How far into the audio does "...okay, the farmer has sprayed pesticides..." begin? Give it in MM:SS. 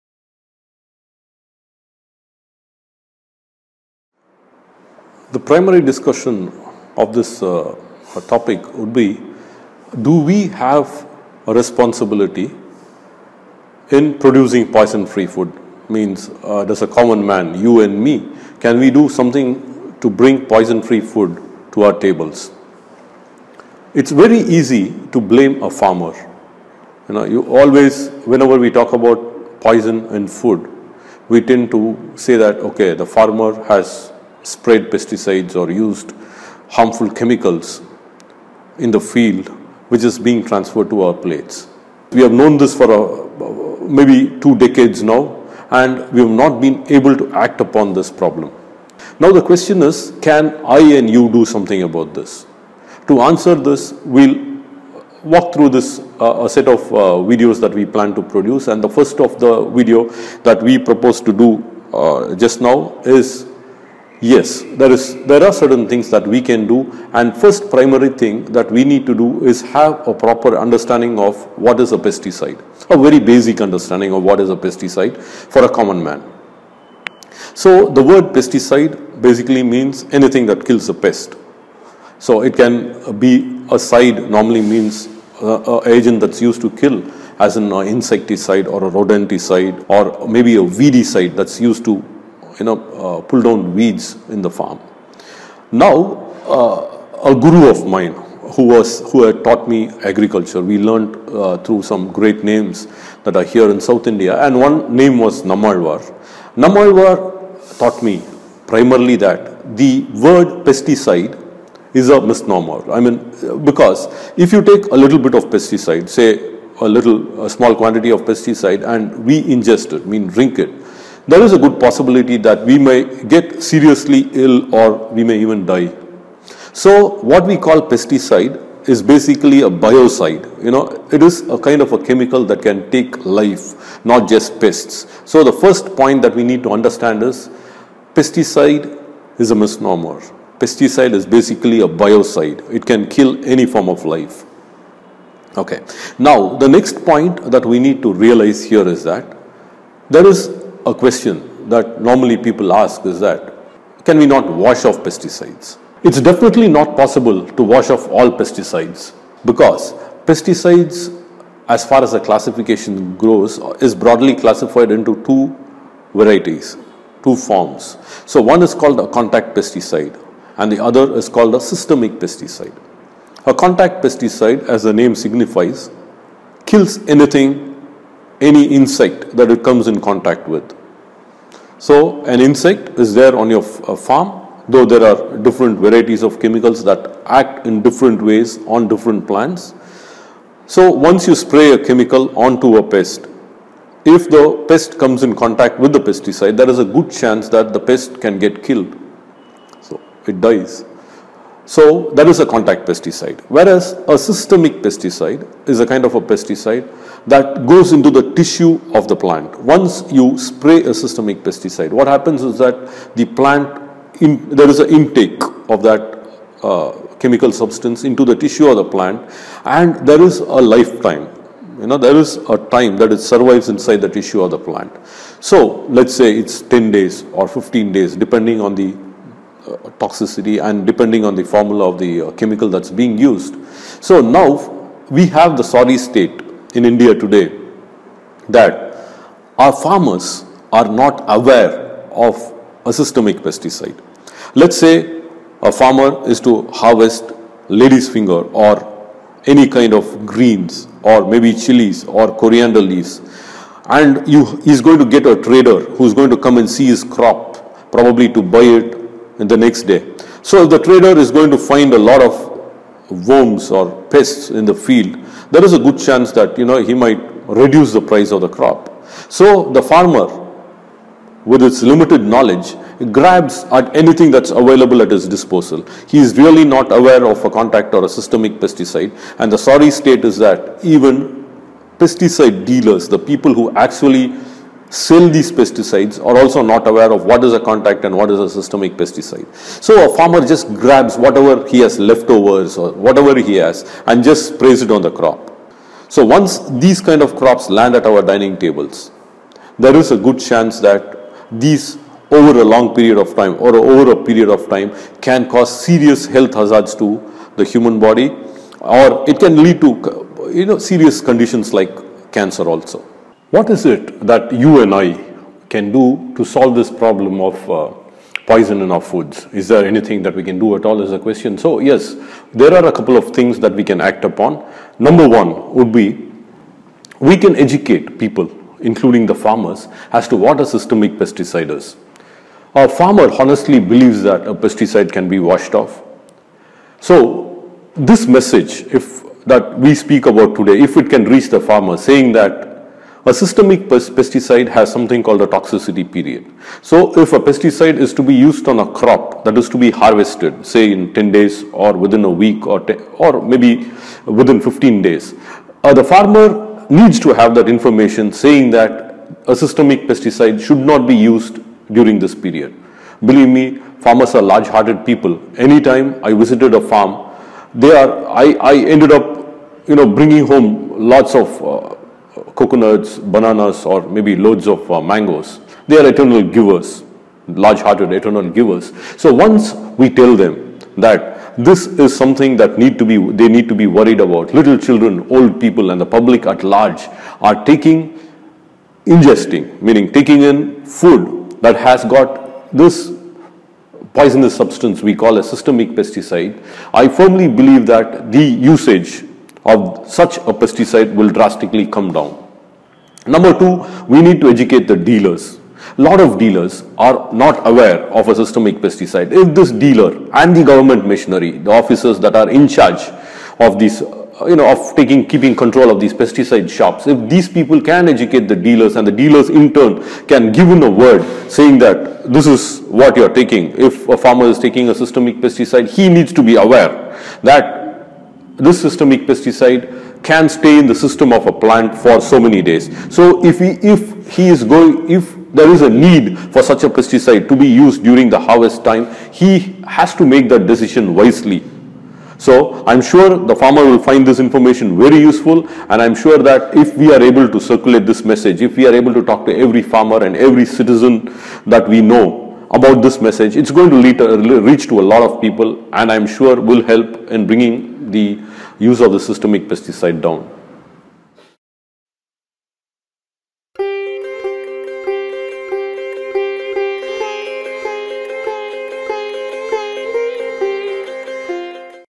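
00:32.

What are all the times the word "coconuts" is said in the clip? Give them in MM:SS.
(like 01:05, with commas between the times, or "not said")
06:12.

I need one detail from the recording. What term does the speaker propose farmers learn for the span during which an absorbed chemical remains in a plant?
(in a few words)
toxicity period.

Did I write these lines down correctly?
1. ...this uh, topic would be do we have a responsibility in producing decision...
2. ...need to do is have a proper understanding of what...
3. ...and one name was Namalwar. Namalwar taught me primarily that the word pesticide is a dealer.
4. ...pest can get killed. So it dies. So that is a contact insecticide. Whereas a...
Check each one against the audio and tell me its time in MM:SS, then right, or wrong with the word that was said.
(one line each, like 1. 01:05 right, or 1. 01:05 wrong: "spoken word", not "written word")
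1. 00:07 wrong: "poison", not "decision"
2. 01:08 right
3. 01:44 wrong: "misnomer", not "dealer"
4. 03:17 wrong: "pesticide", not "insecticide".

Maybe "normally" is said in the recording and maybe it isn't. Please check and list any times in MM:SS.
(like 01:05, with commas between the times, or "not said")
01:24, 02:32.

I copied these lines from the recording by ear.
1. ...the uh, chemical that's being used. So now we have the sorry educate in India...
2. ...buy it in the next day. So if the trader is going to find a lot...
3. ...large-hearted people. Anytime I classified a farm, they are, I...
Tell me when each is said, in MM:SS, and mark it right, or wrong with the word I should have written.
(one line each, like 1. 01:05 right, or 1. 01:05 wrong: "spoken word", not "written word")
1. 03:51 wrong: "state", not "educate"
2. 04:18 right
3. 06:04 wrong: "visited", not "classified".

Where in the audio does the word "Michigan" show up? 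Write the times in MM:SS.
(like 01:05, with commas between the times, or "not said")
not said.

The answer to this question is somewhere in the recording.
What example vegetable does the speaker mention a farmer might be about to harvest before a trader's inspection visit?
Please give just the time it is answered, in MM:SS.
04:07.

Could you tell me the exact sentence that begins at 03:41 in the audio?
You know, there is a time that it survives inside the tissue of the plant.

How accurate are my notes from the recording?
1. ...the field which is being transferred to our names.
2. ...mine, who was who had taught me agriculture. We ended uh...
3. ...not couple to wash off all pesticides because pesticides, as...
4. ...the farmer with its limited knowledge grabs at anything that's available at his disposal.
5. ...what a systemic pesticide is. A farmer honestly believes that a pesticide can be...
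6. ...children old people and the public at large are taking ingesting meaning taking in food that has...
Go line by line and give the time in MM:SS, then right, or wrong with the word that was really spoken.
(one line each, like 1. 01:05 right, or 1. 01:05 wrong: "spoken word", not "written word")
1. 00:38 wrong: "plates", not "names"
2. 01:37 wrong: "learned", not "ended"
3. 02:36 wrong: "possible", not "couple"
4. 04:29 right
5. 05:30 right
6. 06:24 right.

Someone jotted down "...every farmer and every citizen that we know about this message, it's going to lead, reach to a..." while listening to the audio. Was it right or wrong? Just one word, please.
right.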